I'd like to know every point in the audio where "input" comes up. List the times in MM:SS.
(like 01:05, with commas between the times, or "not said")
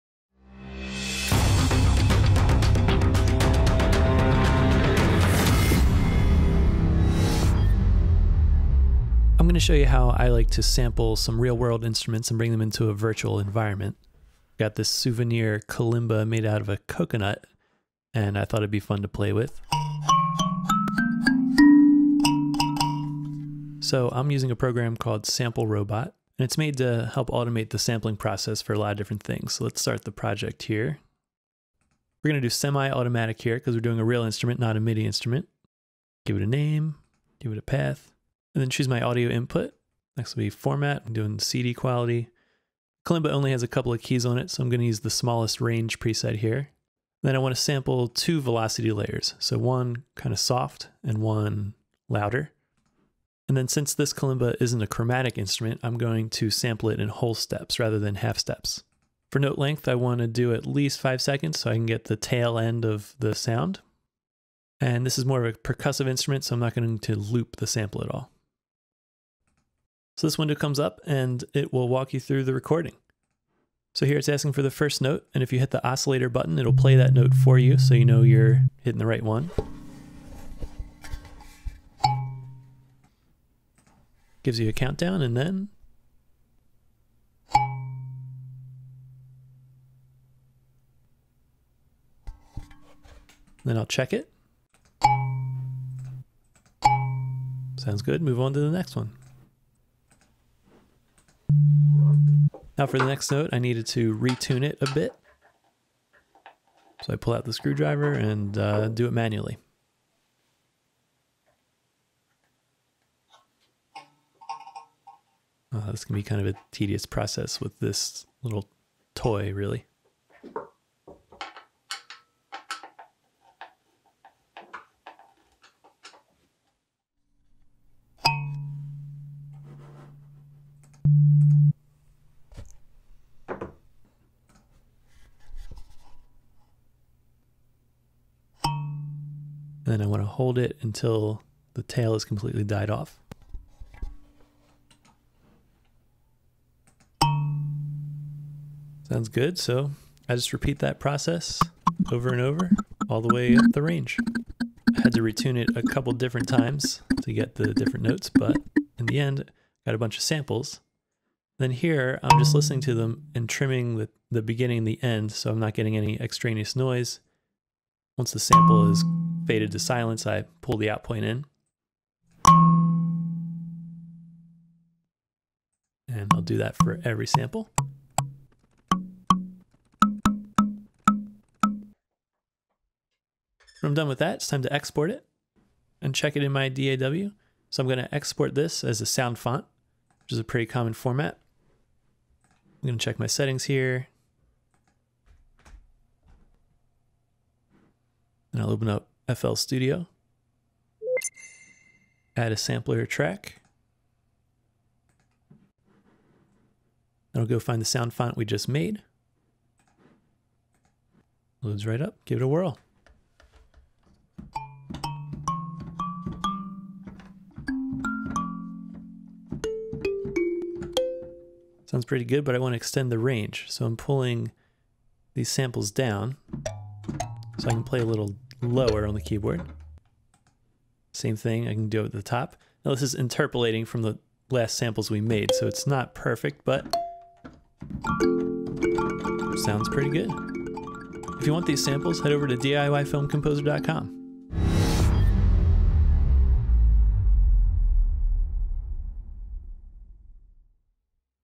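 00:39.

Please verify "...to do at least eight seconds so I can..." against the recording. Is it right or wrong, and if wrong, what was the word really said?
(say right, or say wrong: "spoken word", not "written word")
wrong: "five", not "eight".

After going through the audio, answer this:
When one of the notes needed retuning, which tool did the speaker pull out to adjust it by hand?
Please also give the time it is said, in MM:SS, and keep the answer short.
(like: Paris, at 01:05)
Screwdriver, at 01:47.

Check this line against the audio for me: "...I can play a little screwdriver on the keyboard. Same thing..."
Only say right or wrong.
wrong.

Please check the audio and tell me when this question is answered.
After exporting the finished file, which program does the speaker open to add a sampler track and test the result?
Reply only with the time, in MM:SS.
03:19.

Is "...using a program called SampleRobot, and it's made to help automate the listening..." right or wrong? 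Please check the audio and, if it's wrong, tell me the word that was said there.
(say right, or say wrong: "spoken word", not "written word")
wrong: "sampling", not "listening".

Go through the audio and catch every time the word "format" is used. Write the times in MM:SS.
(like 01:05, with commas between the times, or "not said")
00:40, 03:10.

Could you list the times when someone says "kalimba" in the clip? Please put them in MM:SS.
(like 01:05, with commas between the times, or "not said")
00:15, 00:43, 00:54.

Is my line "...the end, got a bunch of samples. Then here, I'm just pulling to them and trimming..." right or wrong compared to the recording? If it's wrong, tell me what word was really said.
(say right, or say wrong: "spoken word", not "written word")
wrong: "listening", not "pulling".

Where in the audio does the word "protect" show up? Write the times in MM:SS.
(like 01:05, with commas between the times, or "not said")
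not said.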